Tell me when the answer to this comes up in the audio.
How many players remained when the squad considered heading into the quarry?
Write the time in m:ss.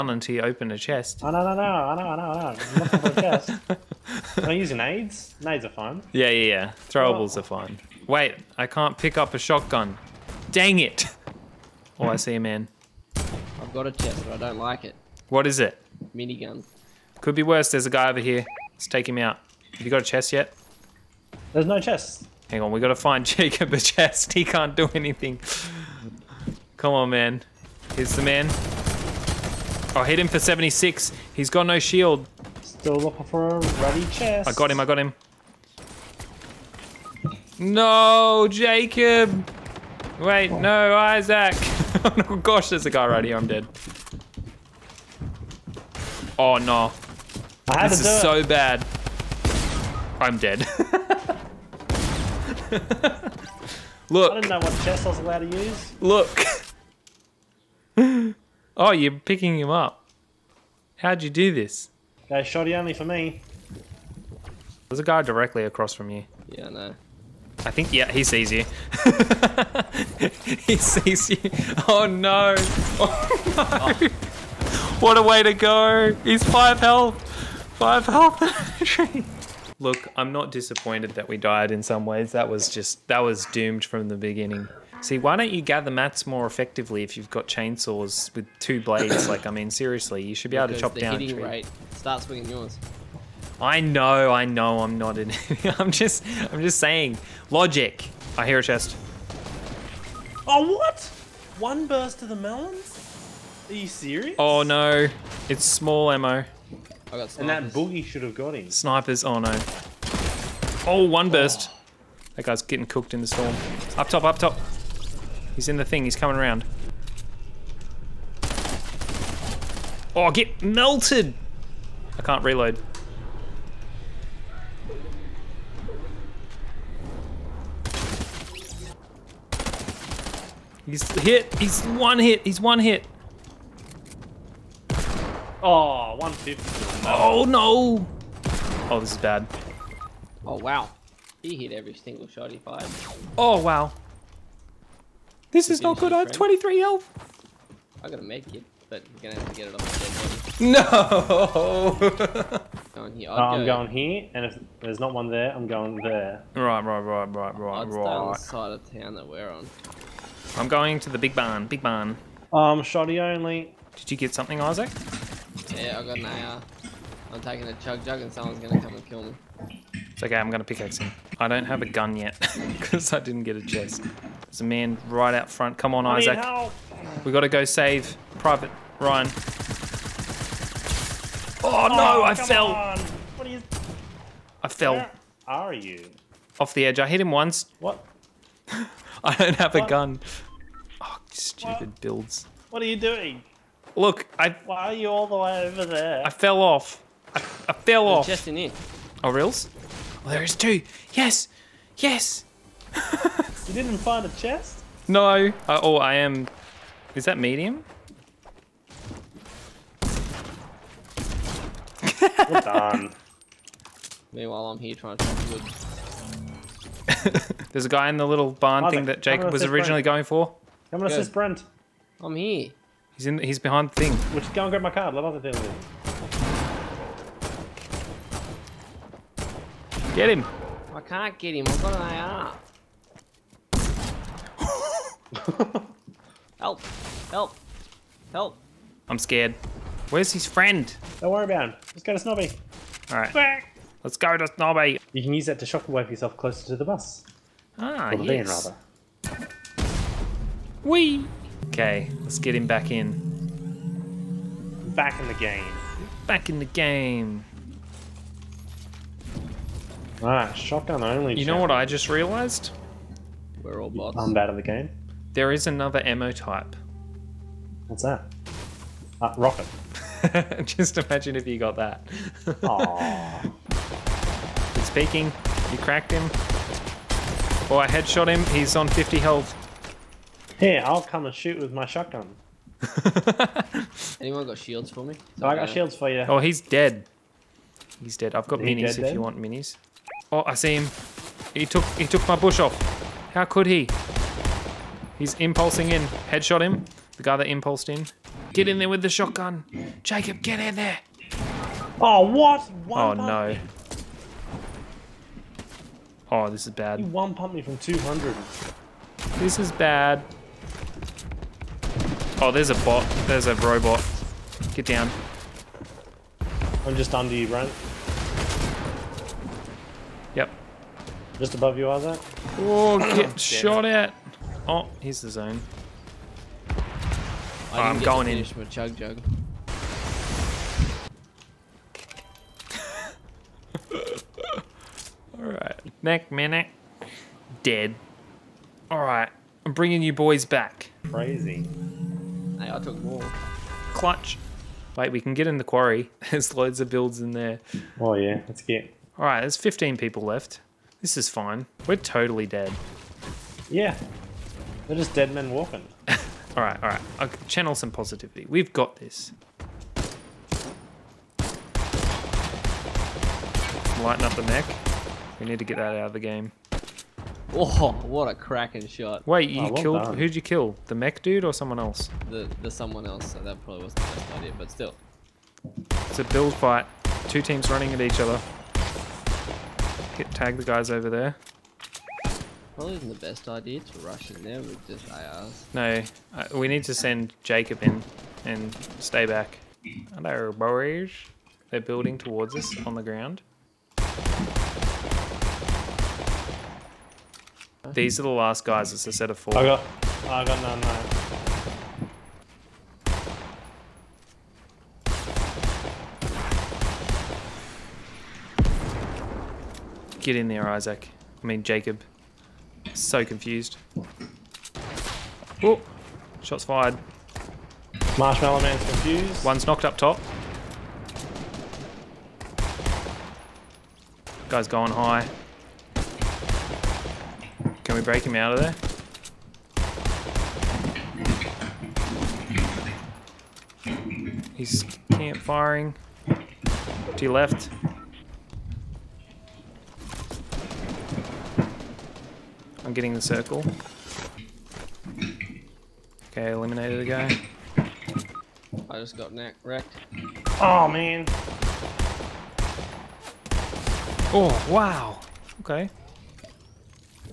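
5:49.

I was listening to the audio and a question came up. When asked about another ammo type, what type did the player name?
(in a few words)
Rocket.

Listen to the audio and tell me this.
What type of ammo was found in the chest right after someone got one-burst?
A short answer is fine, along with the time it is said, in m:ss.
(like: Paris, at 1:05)
Small ammo, at 1:45.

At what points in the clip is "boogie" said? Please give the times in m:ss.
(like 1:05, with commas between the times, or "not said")
1:47.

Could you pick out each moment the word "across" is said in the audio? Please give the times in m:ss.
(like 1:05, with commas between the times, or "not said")
1:05.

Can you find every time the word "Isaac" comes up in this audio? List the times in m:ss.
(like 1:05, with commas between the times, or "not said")
0:40, 2:44, 2:56, 6:50.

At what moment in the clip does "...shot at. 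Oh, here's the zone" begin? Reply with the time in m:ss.
5:23.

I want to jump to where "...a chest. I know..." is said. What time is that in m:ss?
0:00.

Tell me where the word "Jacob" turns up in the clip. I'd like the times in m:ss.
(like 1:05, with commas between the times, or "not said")
0:23, 0:38, 3:39, 5:00, 6:27, 6:51.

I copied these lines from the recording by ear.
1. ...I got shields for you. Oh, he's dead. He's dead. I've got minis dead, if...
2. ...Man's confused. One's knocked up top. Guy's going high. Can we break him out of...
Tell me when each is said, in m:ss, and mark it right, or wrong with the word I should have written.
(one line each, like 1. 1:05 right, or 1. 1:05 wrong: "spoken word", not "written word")
1. 4:45 right
2. 6:58 right.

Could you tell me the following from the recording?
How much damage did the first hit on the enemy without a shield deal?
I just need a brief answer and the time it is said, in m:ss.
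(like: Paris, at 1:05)
76, at 0:30.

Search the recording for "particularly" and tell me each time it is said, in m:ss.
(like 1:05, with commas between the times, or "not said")
not said.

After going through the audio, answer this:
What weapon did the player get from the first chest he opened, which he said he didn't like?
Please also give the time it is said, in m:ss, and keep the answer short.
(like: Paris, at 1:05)
Minigun, at 0:16.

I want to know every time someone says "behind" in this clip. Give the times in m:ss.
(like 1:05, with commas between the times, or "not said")
3:43.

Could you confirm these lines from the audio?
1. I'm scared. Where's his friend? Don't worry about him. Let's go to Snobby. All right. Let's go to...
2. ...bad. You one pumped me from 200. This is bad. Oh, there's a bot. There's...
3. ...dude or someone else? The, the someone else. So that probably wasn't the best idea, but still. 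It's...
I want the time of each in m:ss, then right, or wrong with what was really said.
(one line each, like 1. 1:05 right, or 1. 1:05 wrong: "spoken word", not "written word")
1. 3:59 right
2. 5:06 right
3. 6:11 right.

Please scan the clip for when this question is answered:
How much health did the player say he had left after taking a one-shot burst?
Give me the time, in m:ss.
2:26.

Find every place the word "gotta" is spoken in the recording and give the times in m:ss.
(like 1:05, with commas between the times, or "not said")
0:22, 2:57.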